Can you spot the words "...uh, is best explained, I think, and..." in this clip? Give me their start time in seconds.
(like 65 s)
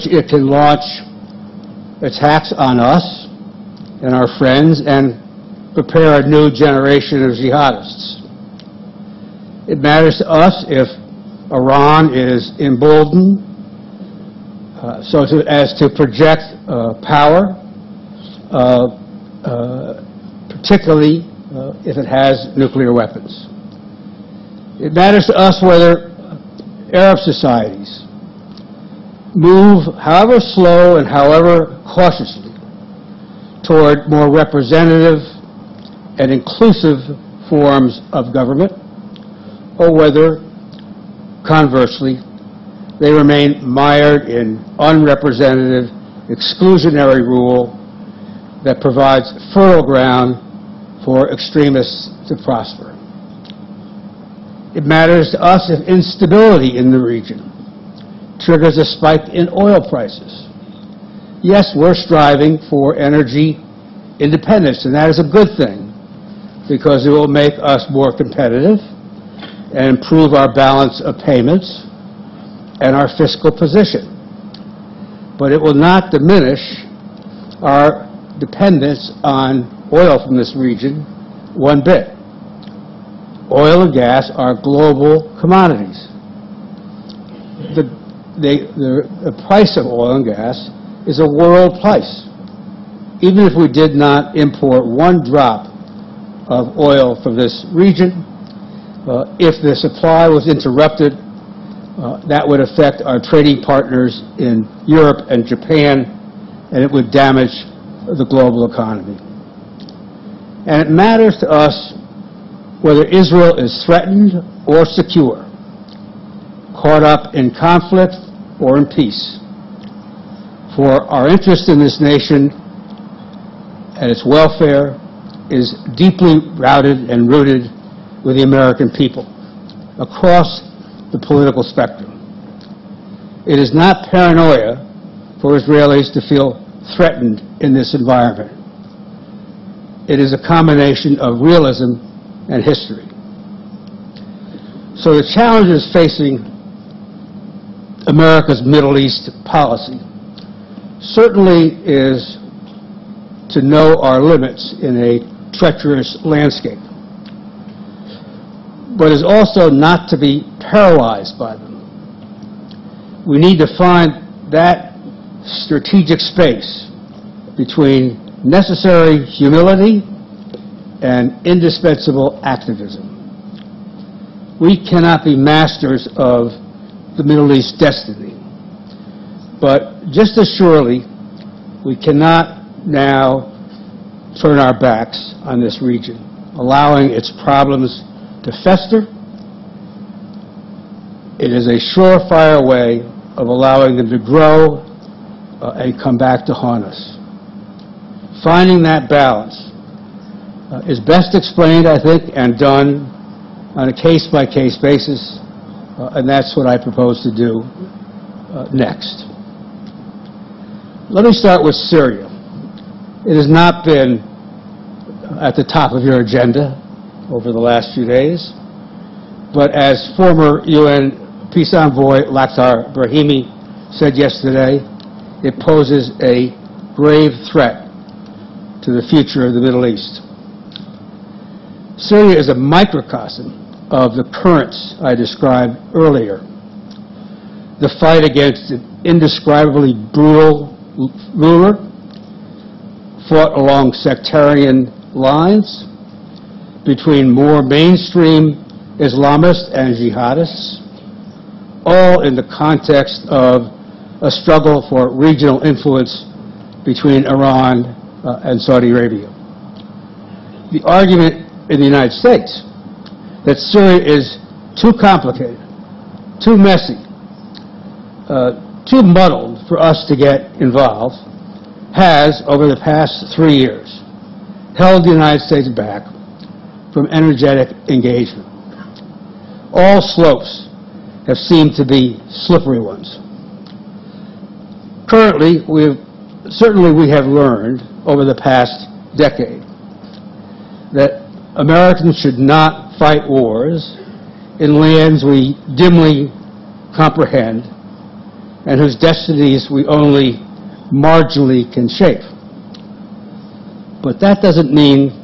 200 s.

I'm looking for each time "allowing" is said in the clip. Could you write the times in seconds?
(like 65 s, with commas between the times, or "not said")
186 s, 193 s.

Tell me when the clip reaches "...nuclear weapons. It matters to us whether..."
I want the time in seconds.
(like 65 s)
22 s.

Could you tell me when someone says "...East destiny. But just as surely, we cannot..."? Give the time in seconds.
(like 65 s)
177 s.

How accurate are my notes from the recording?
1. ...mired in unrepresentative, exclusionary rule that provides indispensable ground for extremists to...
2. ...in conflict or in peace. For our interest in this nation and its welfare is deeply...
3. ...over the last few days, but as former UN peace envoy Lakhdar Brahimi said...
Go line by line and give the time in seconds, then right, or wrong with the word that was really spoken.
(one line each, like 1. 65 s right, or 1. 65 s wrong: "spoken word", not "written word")
1. 43 s wrong: "fertile", not "indispensable"
2. 117 s right
3. 217 s right.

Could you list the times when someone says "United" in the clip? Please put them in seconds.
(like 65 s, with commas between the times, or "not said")
261 s, 275 s.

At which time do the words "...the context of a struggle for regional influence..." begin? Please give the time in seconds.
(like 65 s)
252 s.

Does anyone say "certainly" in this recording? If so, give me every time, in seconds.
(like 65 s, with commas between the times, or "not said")
150 s, 286 s.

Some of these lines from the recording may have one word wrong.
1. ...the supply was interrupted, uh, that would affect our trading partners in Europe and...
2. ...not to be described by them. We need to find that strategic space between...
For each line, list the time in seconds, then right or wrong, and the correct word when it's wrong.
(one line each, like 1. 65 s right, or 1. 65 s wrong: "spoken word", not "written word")
1. 99 s right
2. 159 s wrong: "paralyzed", not "described".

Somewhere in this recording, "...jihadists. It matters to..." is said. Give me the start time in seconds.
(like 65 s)
7 s.